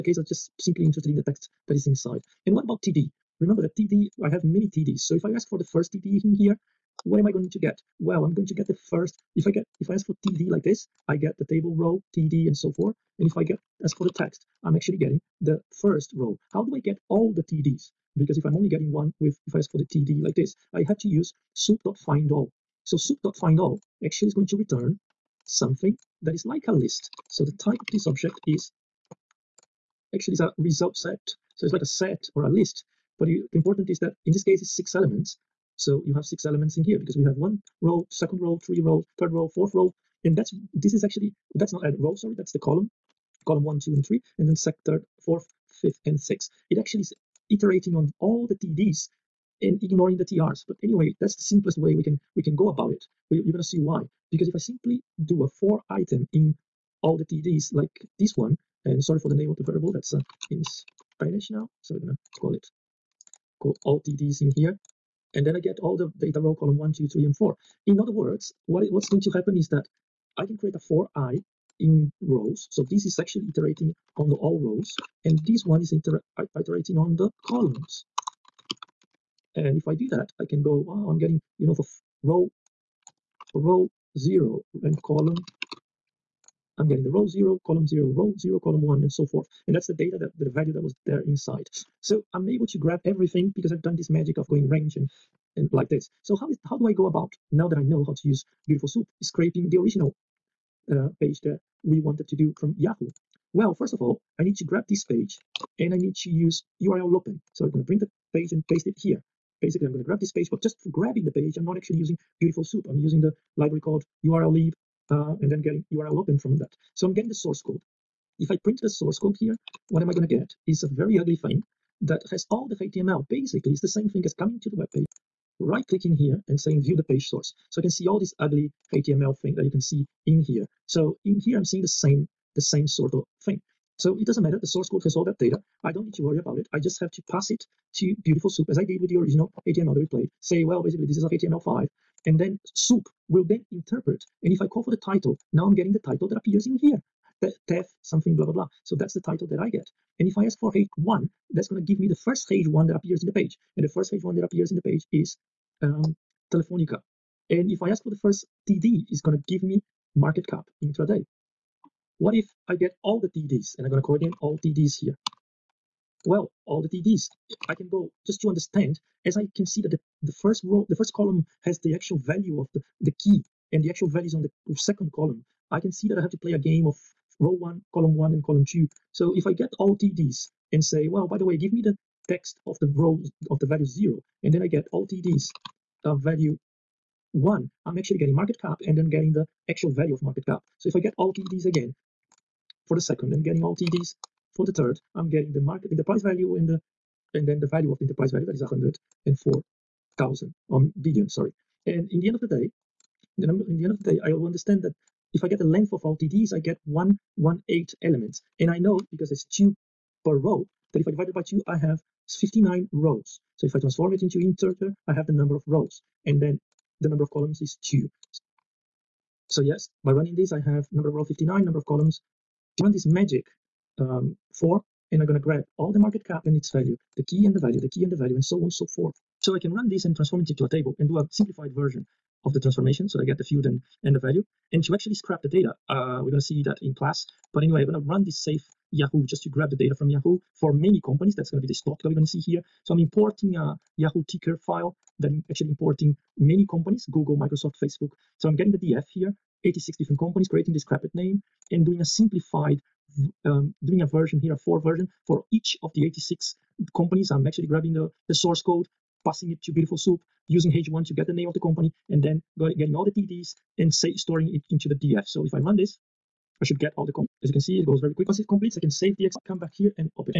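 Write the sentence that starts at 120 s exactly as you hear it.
Is a very ugly thing that has all the HTML.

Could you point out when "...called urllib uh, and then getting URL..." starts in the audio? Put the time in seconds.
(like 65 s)
113 s.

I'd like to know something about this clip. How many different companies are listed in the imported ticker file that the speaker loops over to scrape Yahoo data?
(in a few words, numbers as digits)
86.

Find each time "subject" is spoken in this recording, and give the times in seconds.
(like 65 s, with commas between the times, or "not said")
not said.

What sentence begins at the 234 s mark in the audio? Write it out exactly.
And to actually scrap the data, uh, we're going to see that in class.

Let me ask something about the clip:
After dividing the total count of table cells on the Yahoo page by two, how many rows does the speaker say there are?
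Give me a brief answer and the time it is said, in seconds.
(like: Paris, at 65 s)
59, at 212 s.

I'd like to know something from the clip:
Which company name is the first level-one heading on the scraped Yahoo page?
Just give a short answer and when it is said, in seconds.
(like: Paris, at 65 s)
Telefonica, at 156 s.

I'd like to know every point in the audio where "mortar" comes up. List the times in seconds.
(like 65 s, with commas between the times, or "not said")
not said.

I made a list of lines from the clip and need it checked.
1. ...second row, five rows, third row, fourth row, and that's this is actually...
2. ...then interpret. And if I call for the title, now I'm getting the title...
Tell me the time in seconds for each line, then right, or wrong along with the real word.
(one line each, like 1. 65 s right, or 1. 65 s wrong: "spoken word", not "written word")
1. 38 s wrong: "three", not "five"
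2. 143 s right.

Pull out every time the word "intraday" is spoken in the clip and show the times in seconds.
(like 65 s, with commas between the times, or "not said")
160 s.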